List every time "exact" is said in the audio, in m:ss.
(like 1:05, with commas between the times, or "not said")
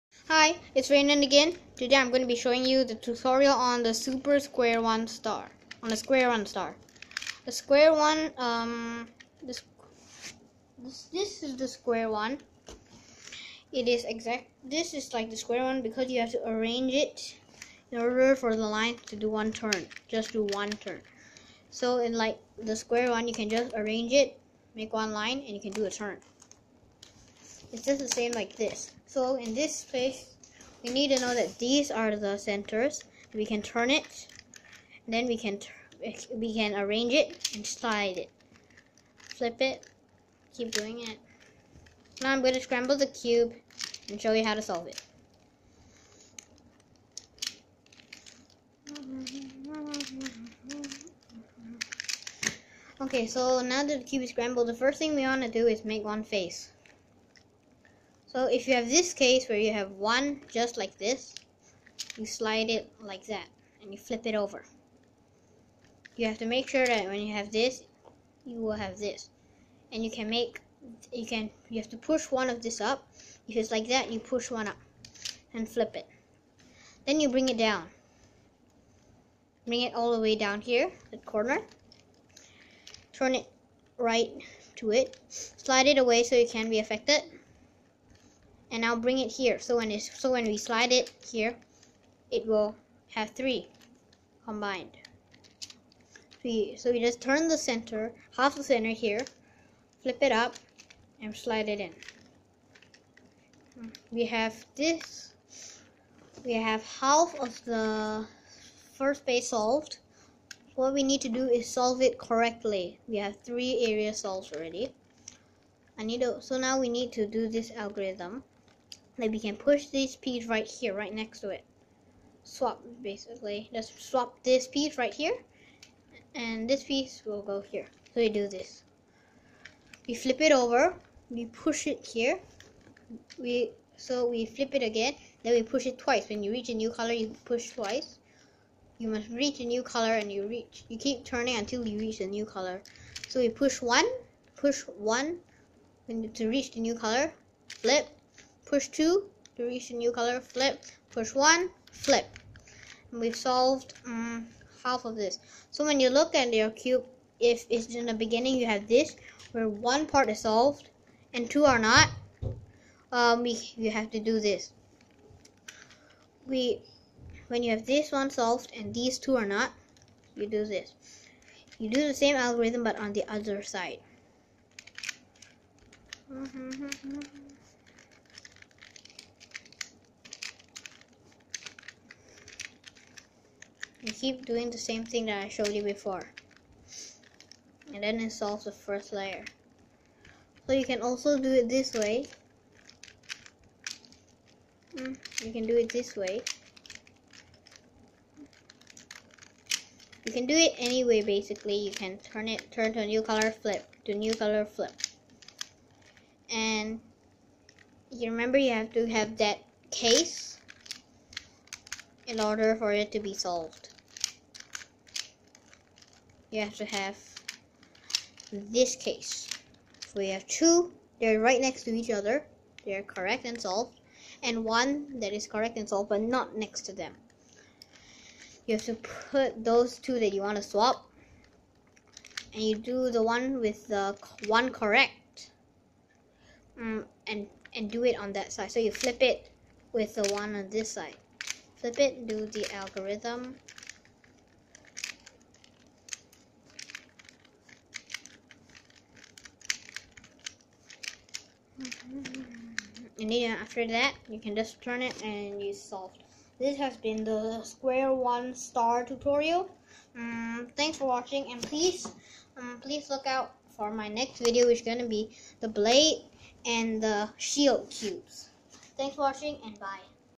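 0:14.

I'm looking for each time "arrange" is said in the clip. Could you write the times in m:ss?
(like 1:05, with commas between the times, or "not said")
0:16, 0:23, 0:36.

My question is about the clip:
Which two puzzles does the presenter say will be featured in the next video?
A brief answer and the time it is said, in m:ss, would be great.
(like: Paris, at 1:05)
The Blade and the Shield, at 4:25.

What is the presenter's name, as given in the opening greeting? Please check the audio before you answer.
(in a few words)
Raynan.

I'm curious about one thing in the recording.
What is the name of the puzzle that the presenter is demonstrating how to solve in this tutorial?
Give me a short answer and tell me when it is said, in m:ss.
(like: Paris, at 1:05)
Super Square One Star, at 0:03.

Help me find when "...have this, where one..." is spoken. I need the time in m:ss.
2:38.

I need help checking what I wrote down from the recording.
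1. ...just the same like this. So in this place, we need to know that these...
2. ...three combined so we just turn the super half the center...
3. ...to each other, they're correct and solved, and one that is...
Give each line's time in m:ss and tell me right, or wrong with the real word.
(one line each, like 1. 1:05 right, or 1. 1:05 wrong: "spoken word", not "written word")
1. 0:27 right
2. 1:33 wrong: "center", not "super"
3. 3:41 right.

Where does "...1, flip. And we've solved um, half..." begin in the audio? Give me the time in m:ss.
2:31.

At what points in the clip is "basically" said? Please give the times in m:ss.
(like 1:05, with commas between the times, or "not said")
2:03, 3:21.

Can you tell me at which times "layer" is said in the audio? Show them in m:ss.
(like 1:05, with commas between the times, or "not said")
3:09.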